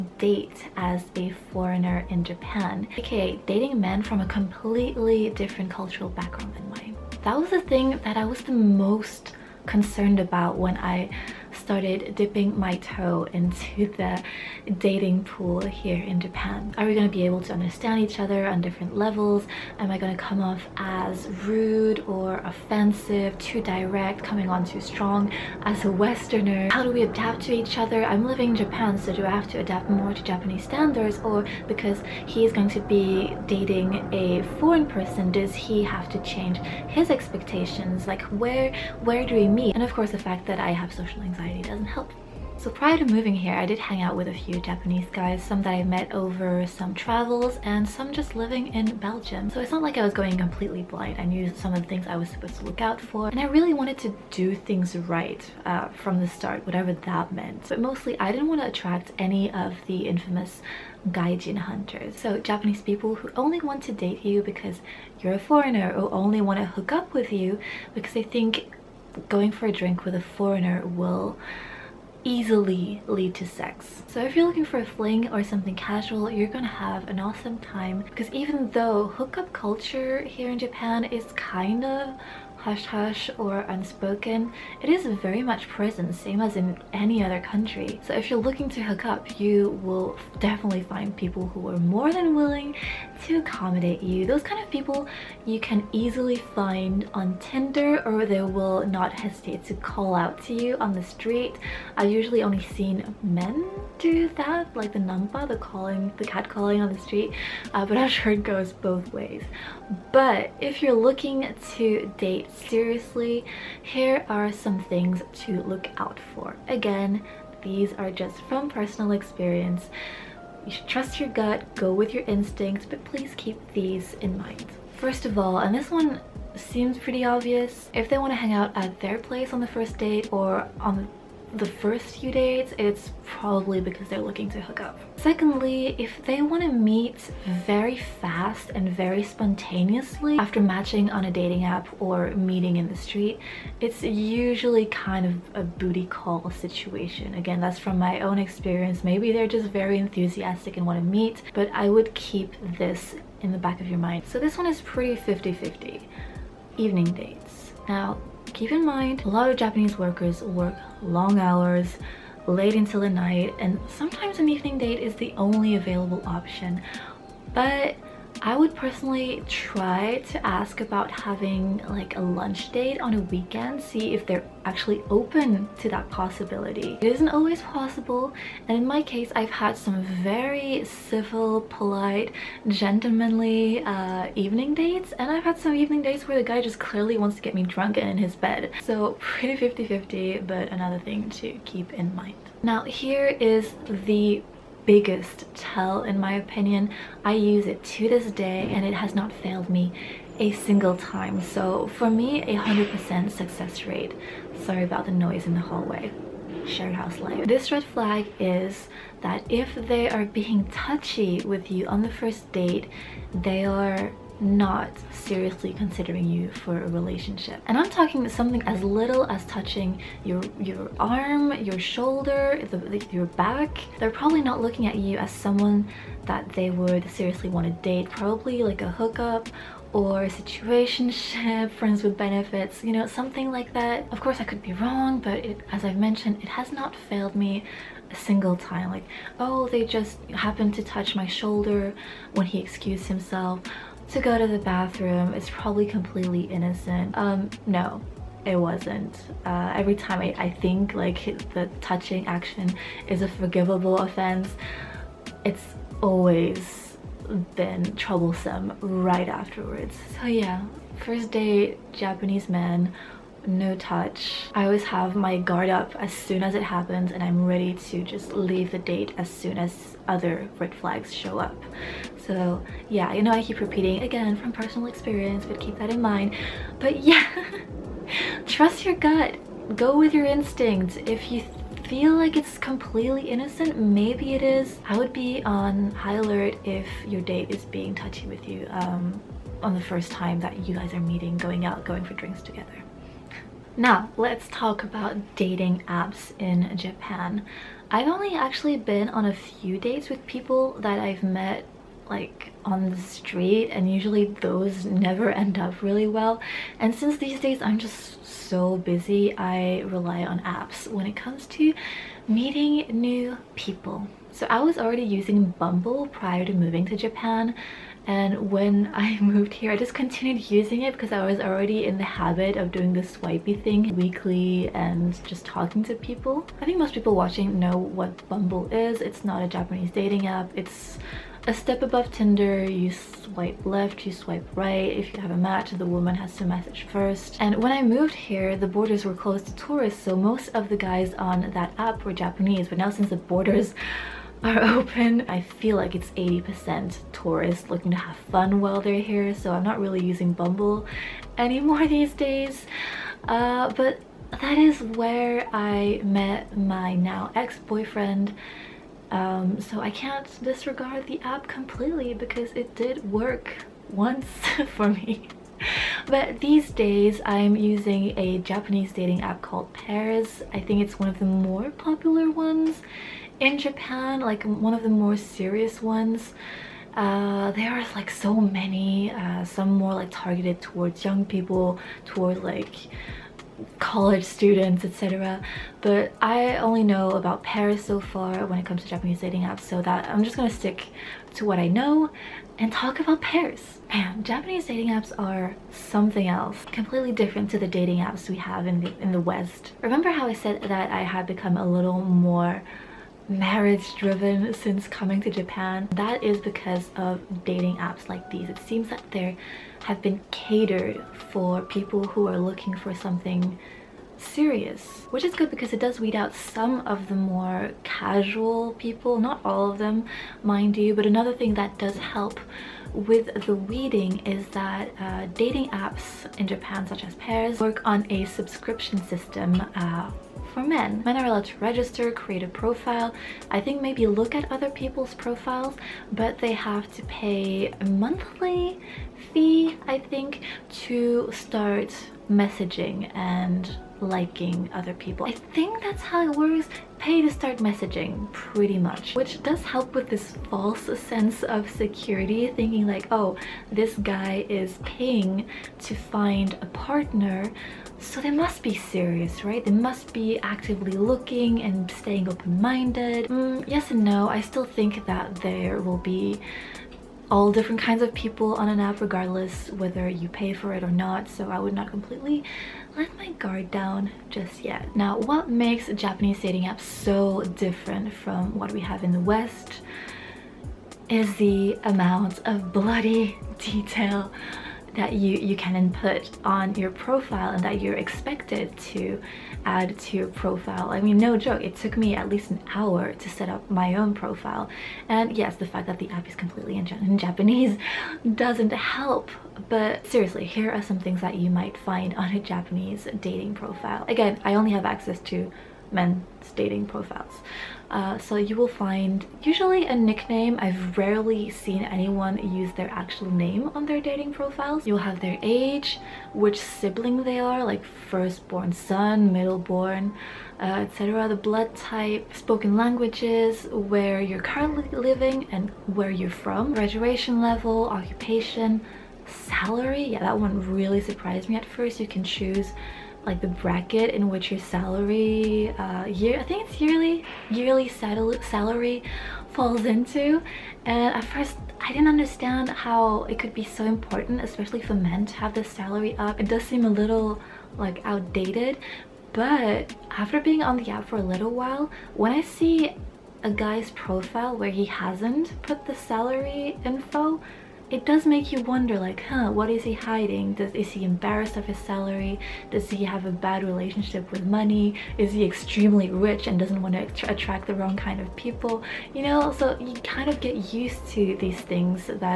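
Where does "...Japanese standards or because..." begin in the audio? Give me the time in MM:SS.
00:30.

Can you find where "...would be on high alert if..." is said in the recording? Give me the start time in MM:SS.
04:44.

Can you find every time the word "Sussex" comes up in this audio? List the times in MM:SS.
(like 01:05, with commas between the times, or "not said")
not said.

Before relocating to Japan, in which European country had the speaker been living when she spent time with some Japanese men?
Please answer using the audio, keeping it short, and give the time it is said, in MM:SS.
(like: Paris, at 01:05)
Belgium, at 00:48.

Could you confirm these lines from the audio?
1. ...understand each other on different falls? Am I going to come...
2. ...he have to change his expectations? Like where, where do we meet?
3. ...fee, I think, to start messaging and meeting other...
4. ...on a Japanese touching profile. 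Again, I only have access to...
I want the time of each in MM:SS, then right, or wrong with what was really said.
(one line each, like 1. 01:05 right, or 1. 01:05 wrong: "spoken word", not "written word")
1. 00:17 wrong: "levels", not "falls"
2. 00:35 right
3. 07:19 wrong: "liking", not "meeting"
4. 08:22 wrong: "dating", not "touching".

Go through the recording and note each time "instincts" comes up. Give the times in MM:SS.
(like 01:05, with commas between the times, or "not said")
02:02, 04:40.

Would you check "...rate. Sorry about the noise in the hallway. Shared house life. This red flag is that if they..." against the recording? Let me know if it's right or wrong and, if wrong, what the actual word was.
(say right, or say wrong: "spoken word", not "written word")
right.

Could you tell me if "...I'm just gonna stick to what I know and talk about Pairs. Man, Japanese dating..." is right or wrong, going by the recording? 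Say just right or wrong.
right.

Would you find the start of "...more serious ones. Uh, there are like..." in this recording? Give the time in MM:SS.
06:14.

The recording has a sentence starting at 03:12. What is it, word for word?
Now here is the biggest tell in my opinion.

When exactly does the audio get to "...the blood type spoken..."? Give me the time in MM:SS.
08:41.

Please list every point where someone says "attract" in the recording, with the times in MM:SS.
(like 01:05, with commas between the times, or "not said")
00:58, 09:27.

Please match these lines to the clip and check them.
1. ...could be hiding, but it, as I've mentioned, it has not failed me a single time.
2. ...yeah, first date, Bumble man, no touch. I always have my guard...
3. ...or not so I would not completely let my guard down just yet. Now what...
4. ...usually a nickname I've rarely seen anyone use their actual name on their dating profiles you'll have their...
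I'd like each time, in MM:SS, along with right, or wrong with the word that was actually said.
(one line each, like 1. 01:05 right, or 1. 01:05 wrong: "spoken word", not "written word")
1. 03:54 wrong: "wrong", not "hiding"
2. 04:20 wrong: "Japanese", not "Bumble"
3. 07:50 right
4. 08:29 right.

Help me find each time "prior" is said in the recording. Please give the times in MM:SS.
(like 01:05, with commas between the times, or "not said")
00:42, 05:16.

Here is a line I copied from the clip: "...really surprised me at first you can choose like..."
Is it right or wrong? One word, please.
right.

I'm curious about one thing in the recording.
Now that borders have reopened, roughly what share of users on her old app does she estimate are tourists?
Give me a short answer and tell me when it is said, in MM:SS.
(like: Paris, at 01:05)
80%, at 05:46.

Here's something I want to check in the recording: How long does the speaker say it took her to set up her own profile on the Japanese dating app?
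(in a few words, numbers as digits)
at least an hour.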